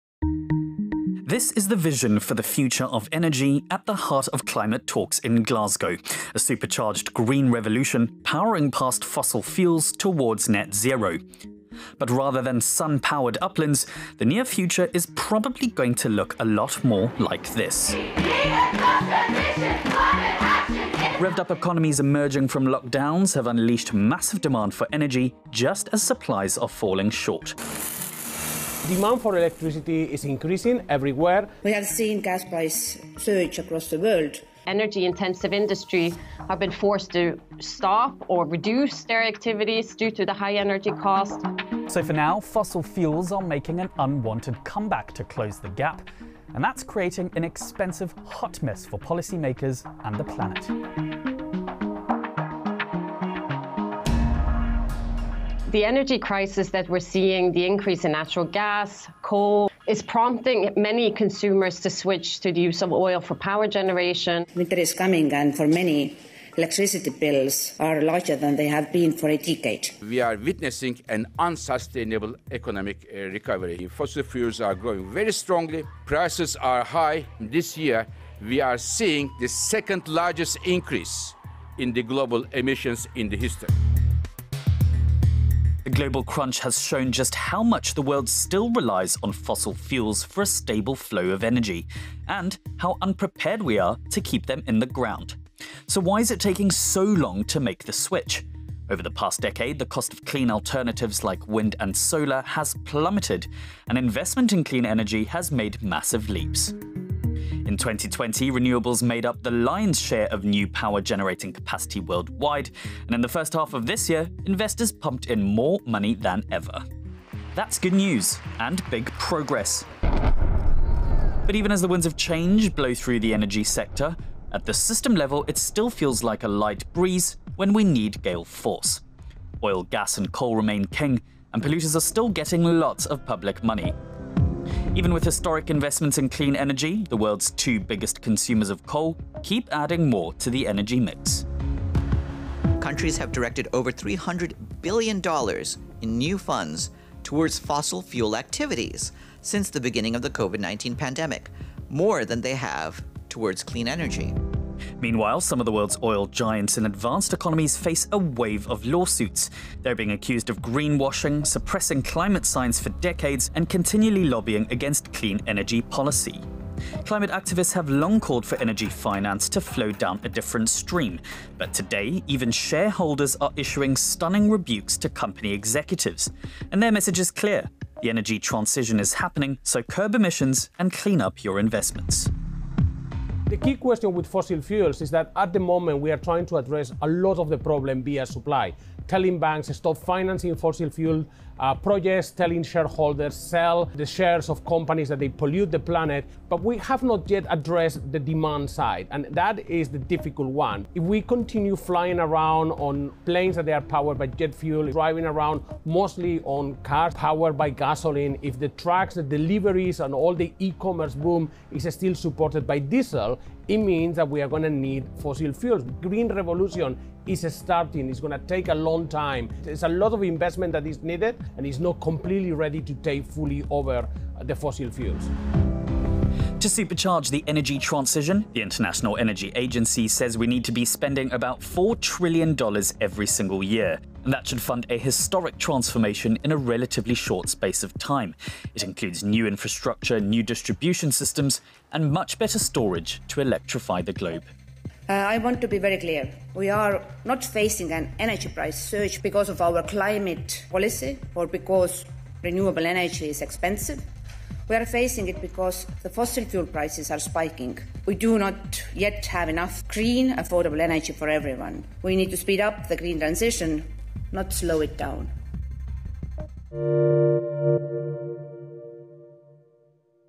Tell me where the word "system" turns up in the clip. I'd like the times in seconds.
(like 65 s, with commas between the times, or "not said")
124 s, 241 s.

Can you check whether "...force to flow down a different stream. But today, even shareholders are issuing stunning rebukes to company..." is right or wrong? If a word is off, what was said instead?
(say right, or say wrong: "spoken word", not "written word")
wrong: "finance", not "force".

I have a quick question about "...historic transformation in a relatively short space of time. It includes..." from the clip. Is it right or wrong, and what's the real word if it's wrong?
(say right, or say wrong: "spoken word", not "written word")
right.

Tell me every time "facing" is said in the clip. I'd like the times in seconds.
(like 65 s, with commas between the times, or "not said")
247 s, 254 s.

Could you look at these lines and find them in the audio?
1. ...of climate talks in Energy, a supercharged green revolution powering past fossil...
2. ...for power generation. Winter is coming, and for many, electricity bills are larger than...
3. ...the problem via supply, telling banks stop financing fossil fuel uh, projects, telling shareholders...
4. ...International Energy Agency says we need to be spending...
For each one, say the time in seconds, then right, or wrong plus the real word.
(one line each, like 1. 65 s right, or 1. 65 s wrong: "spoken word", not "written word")
1. 4 s wrong: "Glasgow", not "Energy"
2. 63 s right
3. 187 s right
4. 228 s right.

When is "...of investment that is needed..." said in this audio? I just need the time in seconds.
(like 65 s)
220 s.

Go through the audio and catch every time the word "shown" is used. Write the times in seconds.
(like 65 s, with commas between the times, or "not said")
86 s.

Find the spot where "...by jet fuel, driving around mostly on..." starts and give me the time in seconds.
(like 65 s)
204 s.